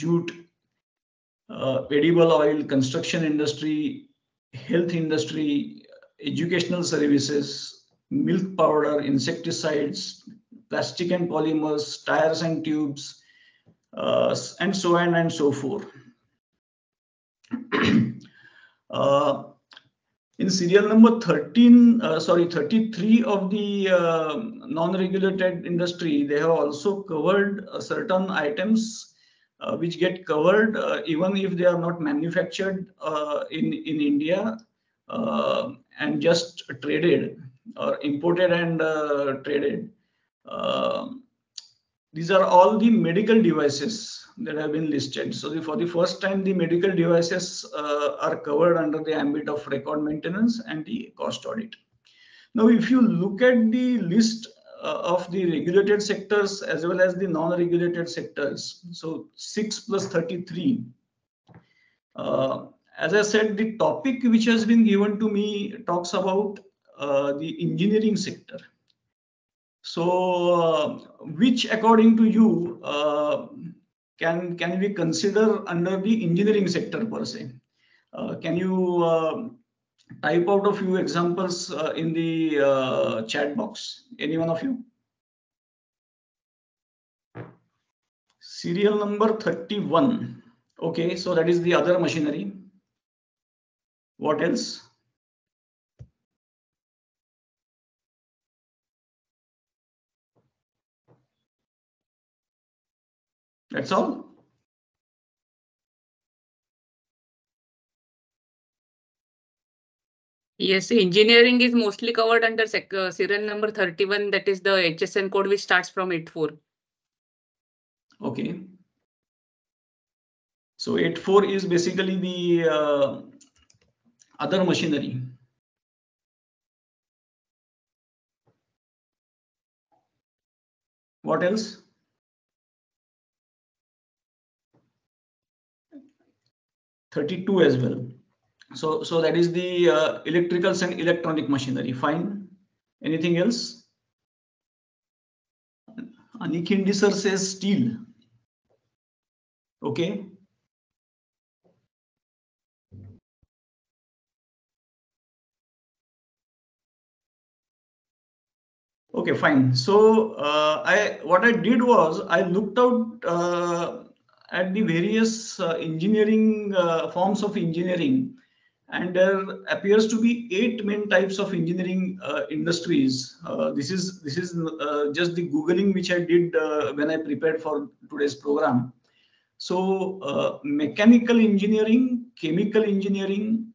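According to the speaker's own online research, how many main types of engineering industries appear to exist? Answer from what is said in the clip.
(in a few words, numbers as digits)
8.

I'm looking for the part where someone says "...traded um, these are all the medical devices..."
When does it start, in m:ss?
0:39.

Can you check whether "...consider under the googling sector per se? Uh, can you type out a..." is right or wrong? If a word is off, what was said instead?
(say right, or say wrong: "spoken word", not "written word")
wrong: "engineering", not "googling".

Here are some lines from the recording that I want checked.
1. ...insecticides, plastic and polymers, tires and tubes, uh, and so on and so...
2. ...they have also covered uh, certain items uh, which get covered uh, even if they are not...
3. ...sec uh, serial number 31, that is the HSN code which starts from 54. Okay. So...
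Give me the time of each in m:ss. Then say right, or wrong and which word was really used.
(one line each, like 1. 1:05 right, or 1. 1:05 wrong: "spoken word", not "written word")
1. 0:09 right
2. 0:26 right
3. 1:52 wrong: "84", not "54".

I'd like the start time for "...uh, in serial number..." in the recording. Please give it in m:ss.
0:18.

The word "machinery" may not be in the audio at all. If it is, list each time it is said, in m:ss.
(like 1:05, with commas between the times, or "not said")
1:31, 2:04, 2:21.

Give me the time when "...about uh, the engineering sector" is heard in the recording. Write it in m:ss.
1:06.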